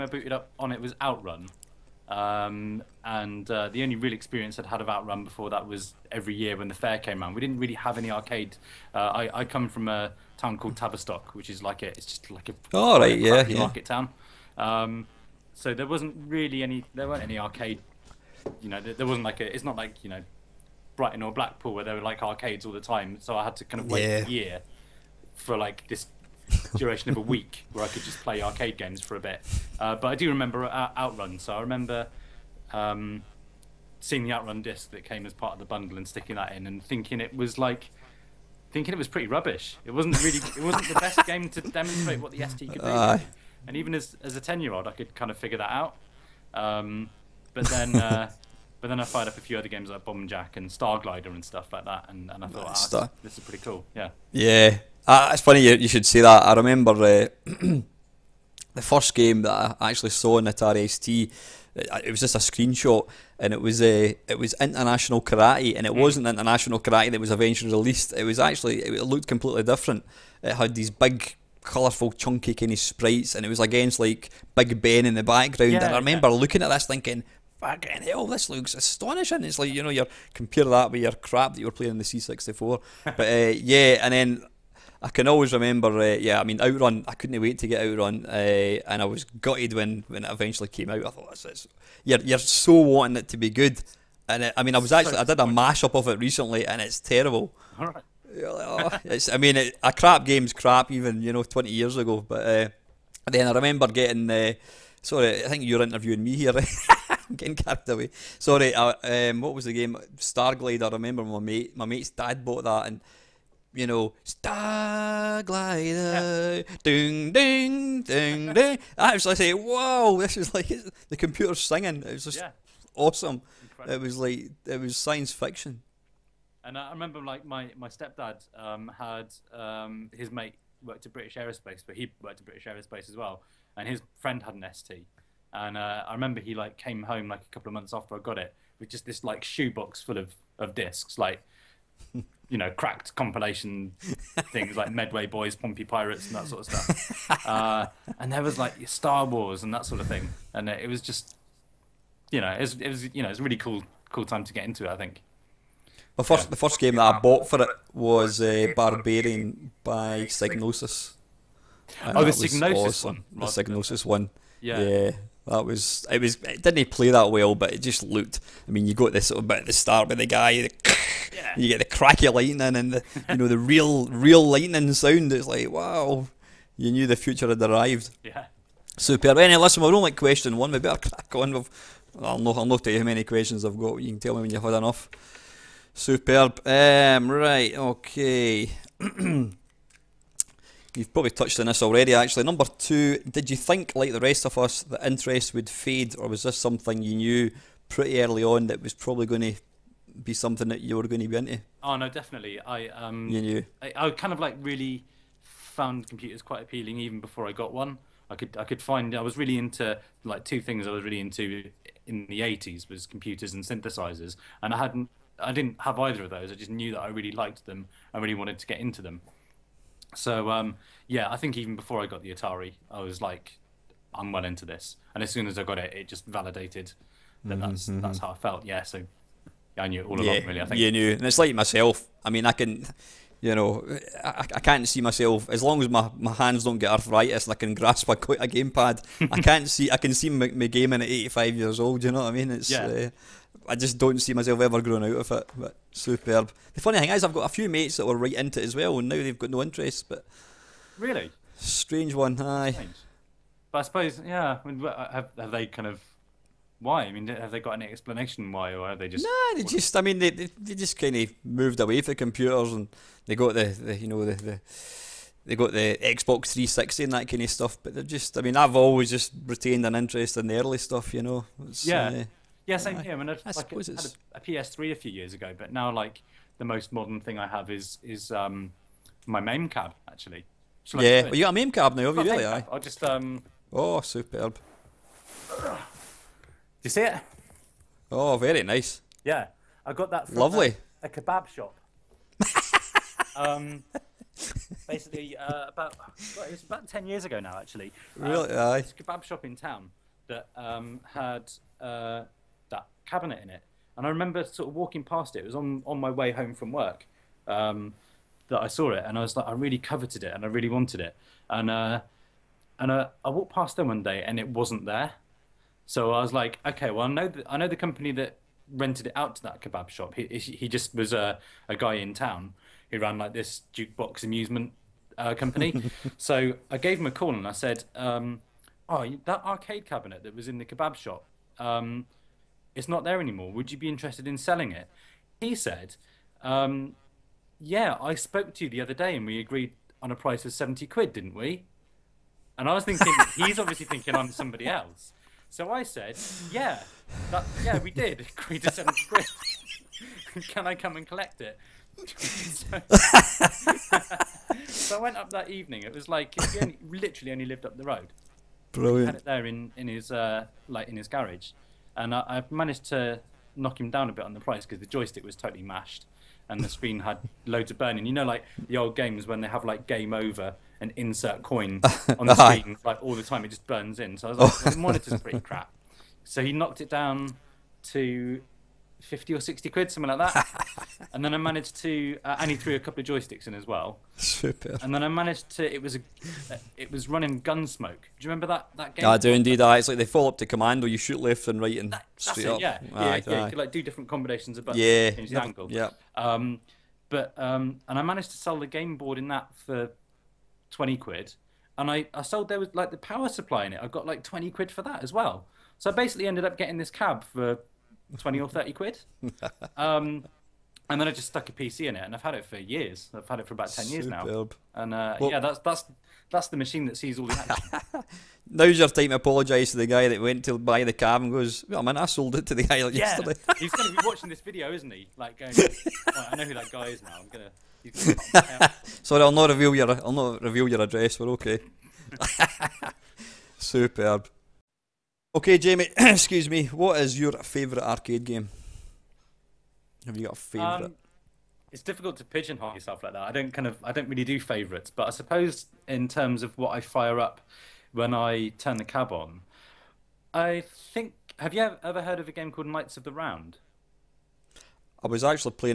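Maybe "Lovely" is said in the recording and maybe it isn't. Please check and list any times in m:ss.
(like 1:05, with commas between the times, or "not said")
4:50.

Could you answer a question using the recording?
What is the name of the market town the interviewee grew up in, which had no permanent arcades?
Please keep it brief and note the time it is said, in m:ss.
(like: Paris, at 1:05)
Tavistock, at 0:10.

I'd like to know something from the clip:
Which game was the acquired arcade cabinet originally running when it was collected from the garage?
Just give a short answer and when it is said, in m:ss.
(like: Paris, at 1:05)
Gunsmoke, at 6:27.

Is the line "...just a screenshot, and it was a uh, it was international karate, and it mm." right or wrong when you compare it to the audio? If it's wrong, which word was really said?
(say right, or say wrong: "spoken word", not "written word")
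right.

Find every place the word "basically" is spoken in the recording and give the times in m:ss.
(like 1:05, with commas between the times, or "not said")
4:54, 6:45.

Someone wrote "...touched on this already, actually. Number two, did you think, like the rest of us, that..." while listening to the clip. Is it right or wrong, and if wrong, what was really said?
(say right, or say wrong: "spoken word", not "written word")
right.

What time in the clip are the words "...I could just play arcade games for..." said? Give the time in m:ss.
0:27.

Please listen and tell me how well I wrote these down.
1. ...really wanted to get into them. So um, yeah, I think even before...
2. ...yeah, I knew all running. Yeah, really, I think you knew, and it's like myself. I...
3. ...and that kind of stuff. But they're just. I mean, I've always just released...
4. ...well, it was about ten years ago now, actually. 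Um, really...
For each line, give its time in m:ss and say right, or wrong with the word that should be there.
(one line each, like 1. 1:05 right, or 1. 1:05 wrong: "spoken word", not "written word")
1. 3:38 right
2. 3:49 wrong: "along", not "running"
3. 4:27 wrong: "retained", not "released"
4. 4:56 right.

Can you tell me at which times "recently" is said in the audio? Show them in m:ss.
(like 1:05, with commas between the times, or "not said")
1:36.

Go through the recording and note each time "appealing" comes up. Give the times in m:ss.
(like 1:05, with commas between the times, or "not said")
3:26.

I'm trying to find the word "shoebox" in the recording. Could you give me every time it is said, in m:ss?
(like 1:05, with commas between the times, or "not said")
2:19.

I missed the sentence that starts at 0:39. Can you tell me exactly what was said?
It wasn't really, it wasn't the best game to demonstrate what the ST could do.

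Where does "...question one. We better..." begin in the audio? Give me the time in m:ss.
3:00.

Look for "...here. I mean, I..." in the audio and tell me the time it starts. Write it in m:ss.
4:32.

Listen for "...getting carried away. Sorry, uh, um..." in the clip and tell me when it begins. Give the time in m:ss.
1:47.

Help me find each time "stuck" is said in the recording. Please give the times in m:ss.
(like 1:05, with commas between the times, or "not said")
6:51.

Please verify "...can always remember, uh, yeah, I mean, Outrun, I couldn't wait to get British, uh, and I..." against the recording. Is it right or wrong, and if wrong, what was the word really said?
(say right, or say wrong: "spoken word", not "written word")
wrong: "Outrun", not "British".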